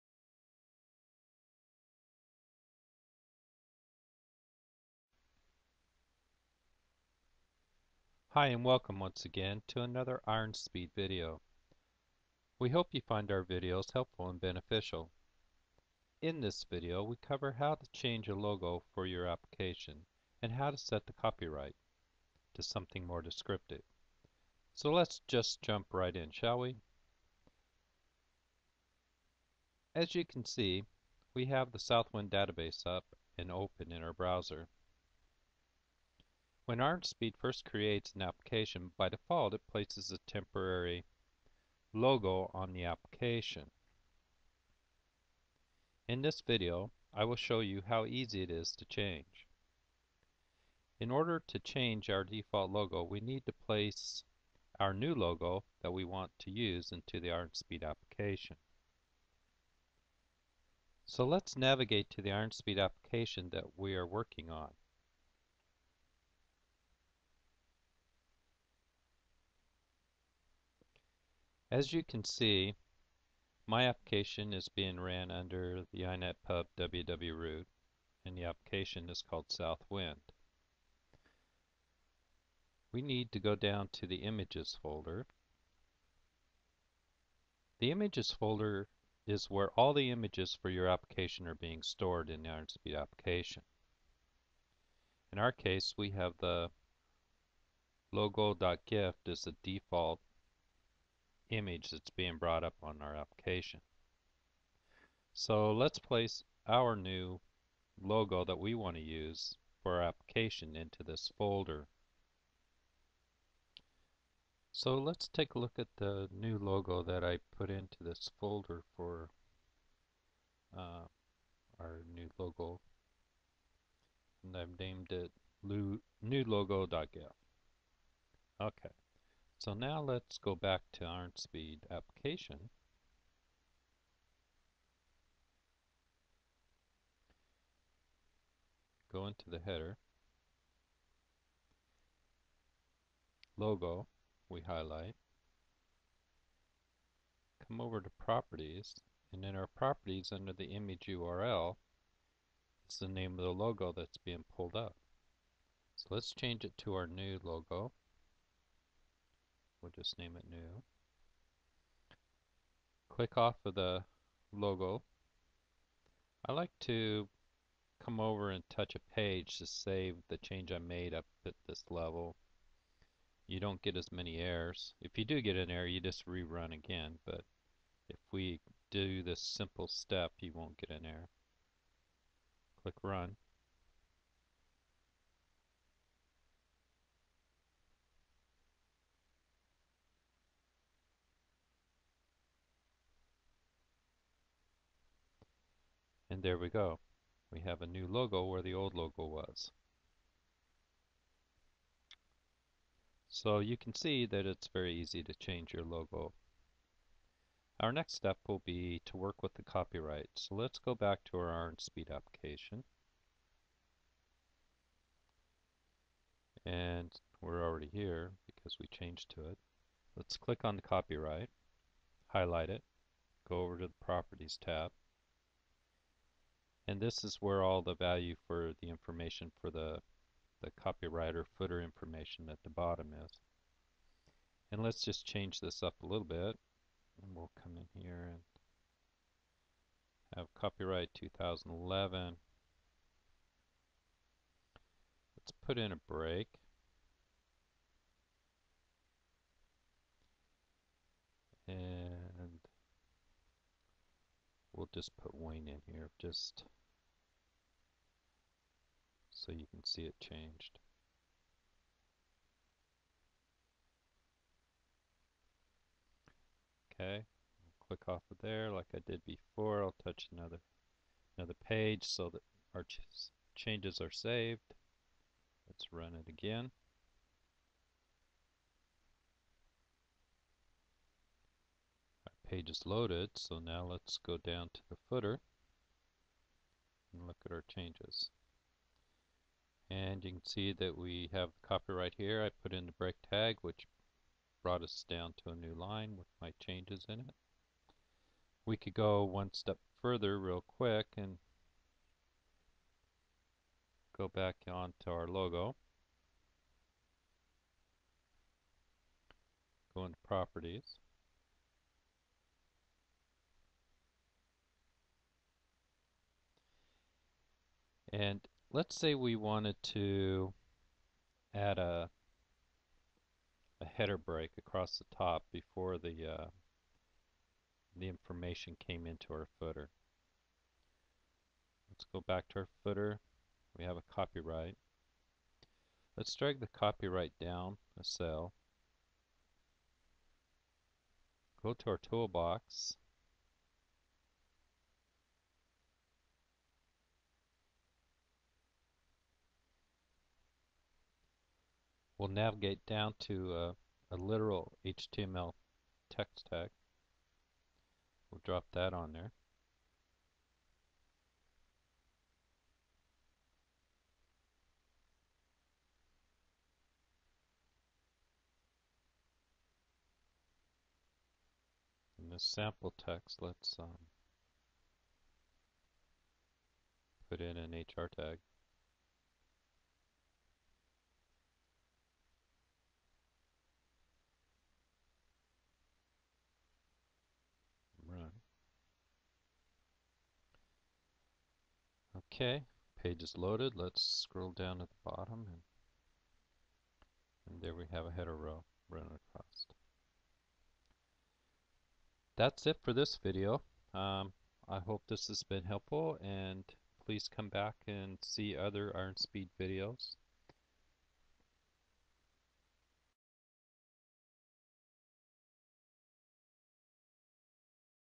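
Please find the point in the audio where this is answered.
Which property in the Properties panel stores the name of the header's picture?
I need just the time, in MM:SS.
02:30.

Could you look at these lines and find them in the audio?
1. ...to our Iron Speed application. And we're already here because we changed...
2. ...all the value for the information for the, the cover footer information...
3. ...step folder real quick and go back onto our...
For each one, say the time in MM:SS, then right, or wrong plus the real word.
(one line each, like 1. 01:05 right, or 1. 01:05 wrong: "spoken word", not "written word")
1. 03:31 right
2. 03:47 wrong: "copywriter", not "cover"
3. 04:59 wrong: "further", not "folder".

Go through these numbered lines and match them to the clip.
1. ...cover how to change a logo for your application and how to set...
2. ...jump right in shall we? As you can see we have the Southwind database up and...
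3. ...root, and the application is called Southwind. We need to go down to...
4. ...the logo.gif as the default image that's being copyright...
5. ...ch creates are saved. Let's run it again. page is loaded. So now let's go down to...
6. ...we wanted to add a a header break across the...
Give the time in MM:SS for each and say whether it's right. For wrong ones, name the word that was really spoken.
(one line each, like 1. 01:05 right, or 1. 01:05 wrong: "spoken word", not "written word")
1. 00:17 right
2. 00:25 right
3. 01:17 right
4. 01:36 wrong: "brought", not "copyright"
5. 04:32 wrong: "changes", not "creates"
6. 05:19 right.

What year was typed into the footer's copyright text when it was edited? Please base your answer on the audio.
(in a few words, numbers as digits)
2011.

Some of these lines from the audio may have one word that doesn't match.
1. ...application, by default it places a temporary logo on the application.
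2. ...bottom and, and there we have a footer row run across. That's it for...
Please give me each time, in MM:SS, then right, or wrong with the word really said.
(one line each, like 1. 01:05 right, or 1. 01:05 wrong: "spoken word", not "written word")
1. 00:38 right
2. 06:35 wrong: "header", not "footer".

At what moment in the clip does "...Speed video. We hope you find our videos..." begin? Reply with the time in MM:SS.
00:10.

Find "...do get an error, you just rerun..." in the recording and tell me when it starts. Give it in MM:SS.
02:55.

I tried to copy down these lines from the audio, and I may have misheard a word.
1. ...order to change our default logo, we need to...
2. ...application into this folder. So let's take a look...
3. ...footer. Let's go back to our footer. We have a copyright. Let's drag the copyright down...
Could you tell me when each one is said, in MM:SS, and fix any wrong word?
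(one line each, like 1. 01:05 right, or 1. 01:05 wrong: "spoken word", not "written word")
1. 00:51 right
2. 01:50 right
3. 05:29 right.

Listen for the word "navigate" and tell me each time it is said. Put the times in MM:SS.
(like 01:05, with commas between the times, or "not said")
01:01, 05:52.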